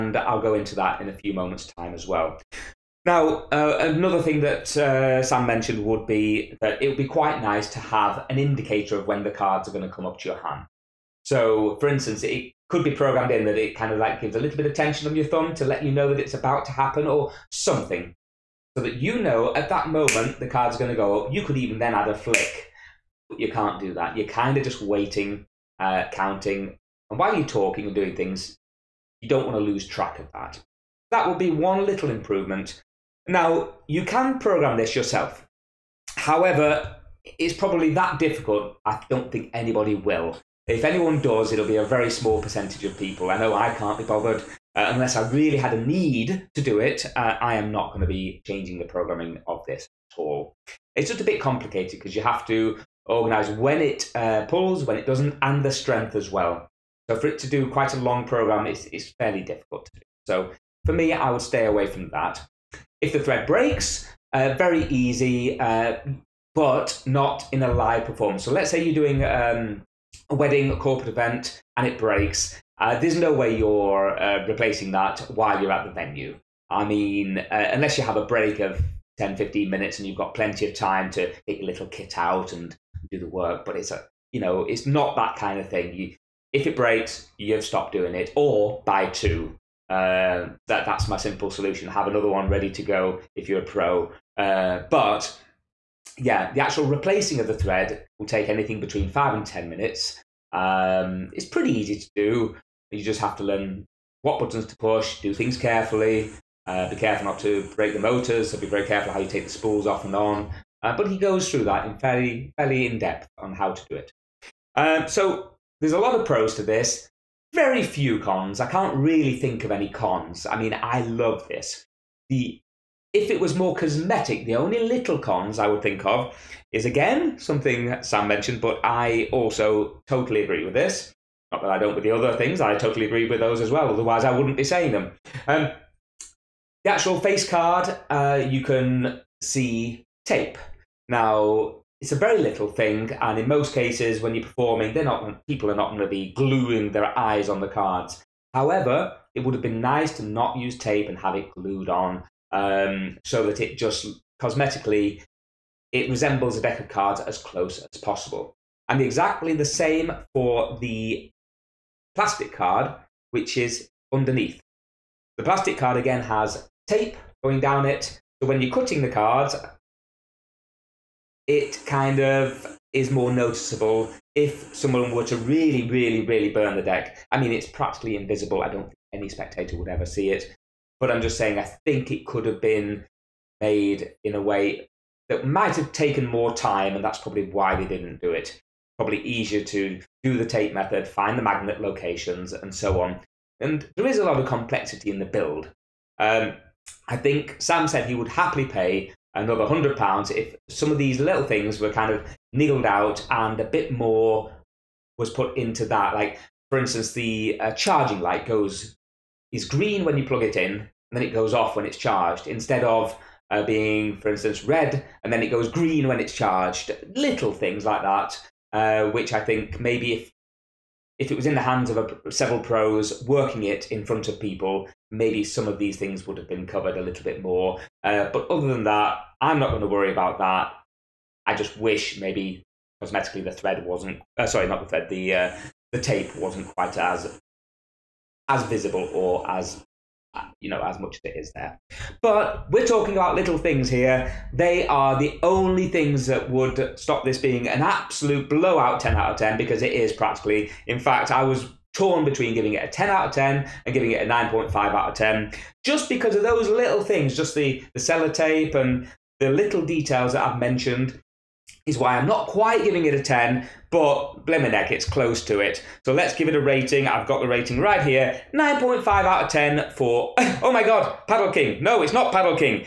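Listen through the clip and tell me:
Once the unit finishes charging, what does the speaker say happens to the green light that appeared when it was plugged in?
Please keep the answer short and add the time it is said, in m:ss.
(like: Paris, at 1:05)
it goes off, at 3:31.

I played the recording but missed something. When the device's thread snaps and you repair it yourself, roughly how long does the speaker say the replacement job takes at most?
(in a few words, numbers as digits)
10 minutes.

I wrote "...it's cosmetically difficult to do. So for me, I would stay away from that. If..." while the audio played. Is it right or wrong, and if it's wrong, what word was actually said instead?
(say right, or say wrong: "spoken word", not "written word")
wrong: "fairly", not "cosmetically".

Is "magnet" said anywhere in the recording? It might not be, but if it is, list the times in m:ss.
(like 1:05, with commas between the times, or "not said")
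3:11.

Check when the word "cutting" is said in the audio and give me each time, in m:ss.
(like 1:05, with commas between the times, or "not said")
2:48.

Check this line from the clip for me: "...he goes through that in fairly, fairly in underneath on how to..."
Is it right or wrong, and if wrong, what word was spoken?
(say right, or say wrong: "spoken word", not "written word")
wrong: "depth", not "underneath".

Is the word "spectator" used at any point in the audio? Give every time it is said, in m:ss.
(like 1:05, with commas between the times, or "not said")
2:59.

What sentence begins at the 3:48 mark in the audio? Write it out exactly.
Uh, but other than that, I'm not going to worry about that.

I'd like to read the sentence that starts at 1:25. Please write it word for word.
You, if it breaks, you've stopped doing it, or buy two.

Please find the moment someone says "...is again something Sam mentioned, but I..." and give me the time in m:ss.
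2:06.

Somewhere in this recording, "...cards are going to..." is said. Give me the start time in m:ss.
0:09.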